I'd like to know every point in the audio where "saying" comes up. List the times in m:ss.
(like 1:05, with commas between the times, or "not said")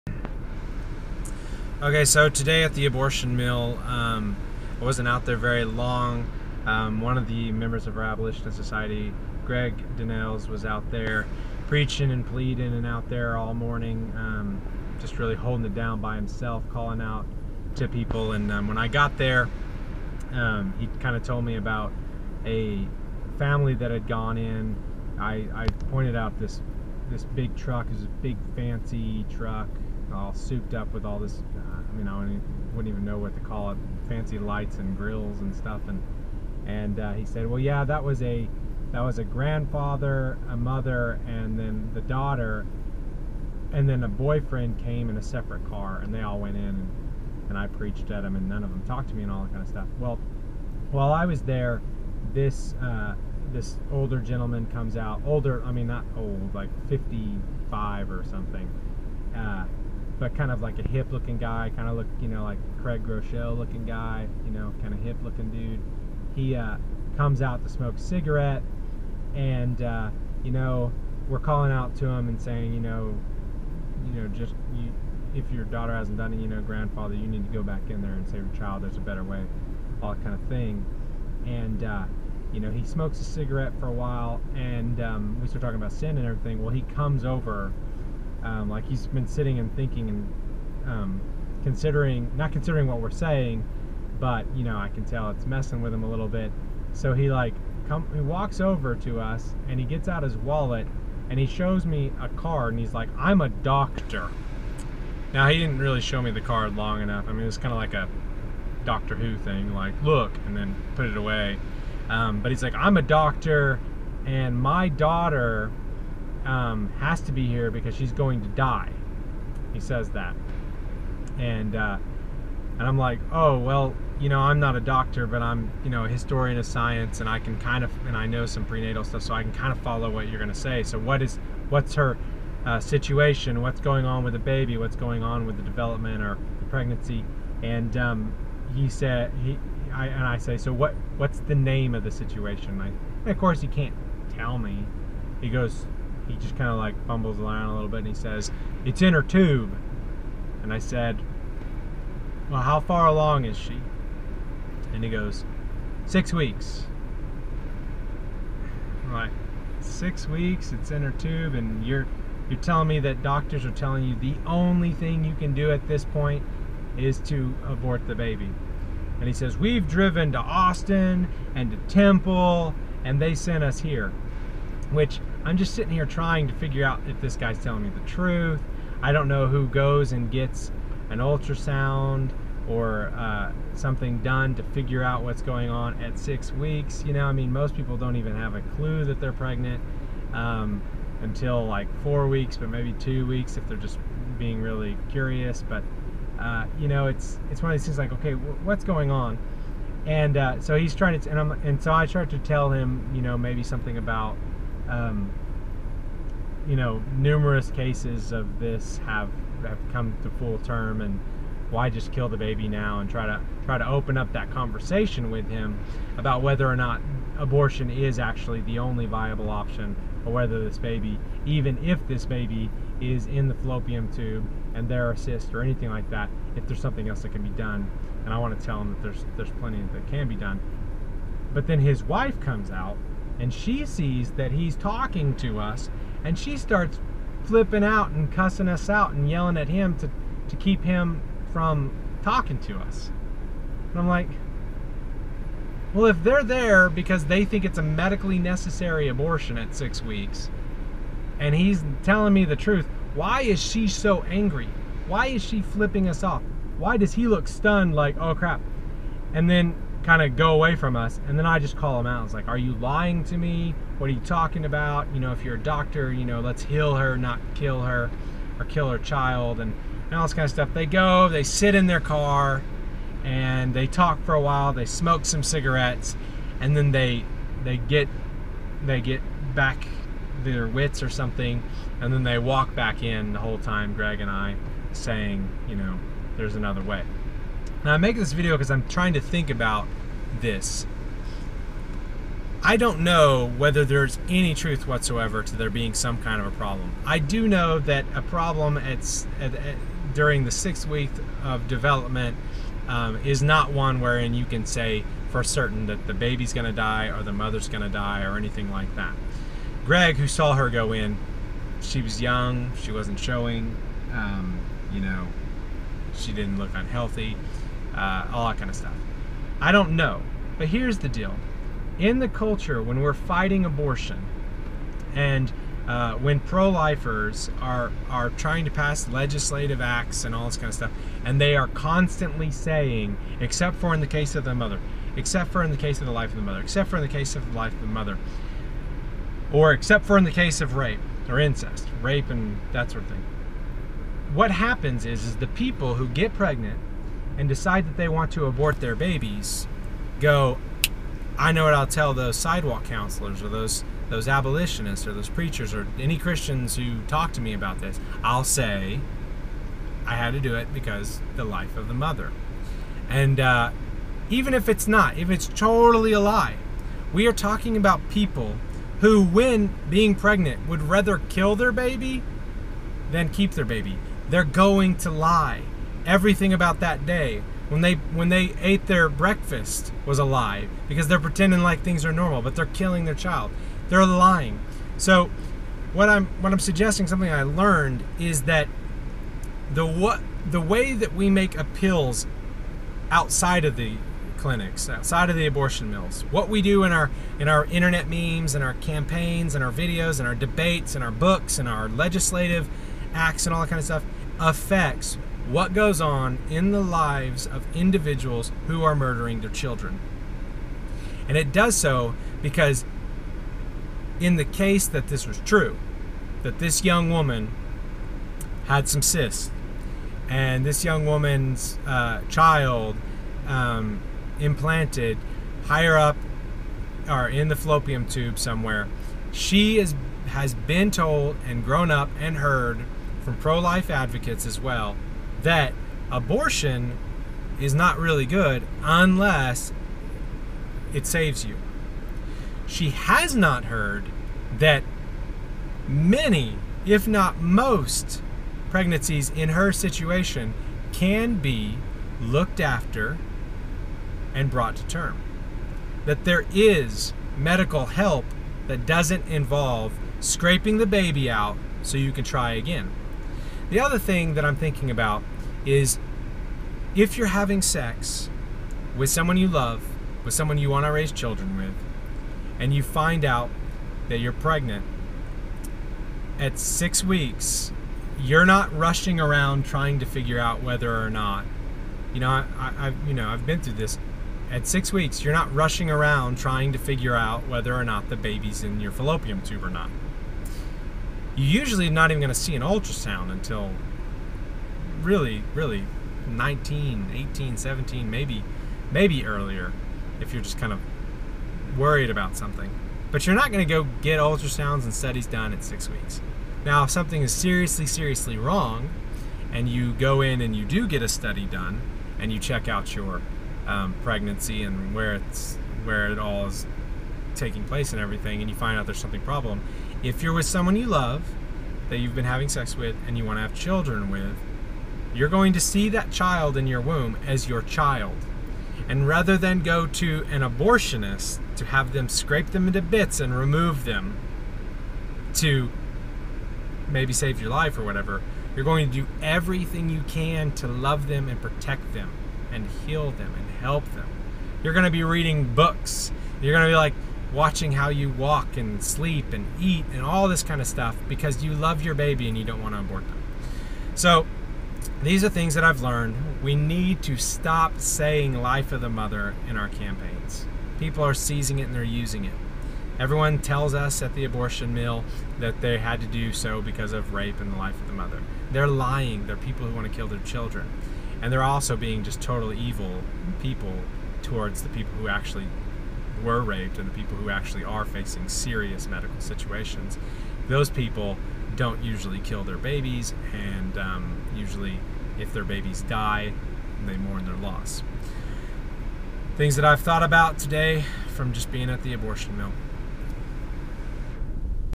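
1:12, 1:33, 4:44, 5:32, 9:17.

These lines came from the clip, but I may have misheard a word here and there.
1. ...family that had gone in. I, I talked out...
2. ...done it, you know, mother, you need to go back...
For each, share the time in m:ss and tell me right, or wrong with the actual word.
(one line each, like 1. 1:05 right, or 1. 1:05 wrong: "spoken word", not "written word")
1. 0:23 wrong: "pointed", not "talked"
2. 1:16 wrong: "grandfather", not "mother".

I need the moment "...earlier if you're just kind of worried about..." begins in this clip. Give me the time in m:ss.
8:19.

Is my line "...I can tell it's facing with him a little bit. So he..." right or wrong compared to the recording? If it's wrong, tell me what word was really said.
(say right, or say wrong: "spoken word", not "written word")
wrong: "messing", not "facing".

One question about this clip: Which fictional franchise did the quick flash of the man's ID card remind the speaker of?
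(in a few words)
Doctor Who.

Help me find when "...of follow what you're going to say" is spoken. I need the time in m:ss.
2:09.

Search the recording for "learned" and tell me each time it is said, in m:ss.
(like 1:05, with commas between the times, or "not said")
6:27, 9:15.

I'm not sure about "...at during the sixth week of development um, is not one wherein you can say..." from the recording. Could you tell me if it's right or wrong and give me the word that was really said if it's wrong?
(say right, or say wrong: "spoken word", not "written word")
right.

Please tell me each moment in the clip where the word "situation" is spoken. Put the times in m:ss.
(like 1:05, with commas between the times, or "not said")
2:12, 2:22, 7:29, 9:39.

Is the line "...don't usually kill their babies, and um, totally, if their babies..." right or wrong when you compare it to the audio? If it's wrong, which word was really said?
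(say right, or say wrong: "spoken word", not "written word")
wrong: "usually", not "totally".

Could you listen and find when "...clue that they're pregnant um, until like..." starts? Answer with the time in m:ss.
3:08.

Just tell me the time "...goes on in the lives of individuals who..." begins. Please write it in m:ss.
6:45.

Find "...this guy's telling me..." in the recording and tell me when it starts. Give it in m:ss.
2:57.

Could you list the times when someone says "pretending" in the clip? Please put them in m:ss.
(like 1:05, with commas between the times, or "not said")
6:21.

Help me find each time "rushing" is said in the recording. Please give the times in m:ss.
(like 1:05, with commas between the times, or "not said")
7:58, 8:05.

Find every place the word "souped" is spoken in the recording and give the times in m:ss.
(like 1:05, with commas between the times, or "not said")
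0:30.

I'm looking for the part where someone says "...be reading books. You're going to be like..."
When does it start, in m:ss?
9:04.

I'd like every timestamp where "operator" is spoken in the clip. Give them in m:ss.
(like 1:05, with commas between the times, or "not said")
not said.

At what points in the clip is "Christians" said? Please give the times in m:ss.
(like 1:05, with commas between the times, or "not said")
5:56.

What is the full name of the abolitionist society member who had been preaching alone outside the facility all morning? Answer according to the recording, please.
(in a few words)
Greg Donnells.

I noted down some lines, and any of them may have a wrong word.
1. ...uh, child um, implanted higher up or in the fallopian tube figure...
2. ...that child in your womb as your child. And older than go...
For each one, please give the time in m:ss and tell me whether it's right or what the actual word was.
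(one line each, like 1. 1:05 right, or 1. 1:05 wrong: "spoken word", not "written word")
1. 7:01 wrong: "somewhere", not "figure"
2. 8:45 wrong: "rather", not "older".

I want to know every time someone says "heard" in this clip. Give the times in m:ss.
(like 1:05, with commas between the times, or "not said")
7:12, 7:23.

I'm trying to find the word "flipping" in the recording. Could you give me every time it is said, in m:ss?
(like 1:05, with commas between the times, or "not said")
3:57, 4:15.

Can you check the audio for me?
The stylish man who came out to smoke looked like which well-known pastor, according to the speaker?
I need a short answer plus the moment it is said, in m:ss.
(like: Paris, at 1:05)
Craig Groeschel, at 1:02.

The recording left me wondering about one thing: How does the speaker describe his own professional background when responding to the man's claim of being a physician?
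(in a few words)
historian of science.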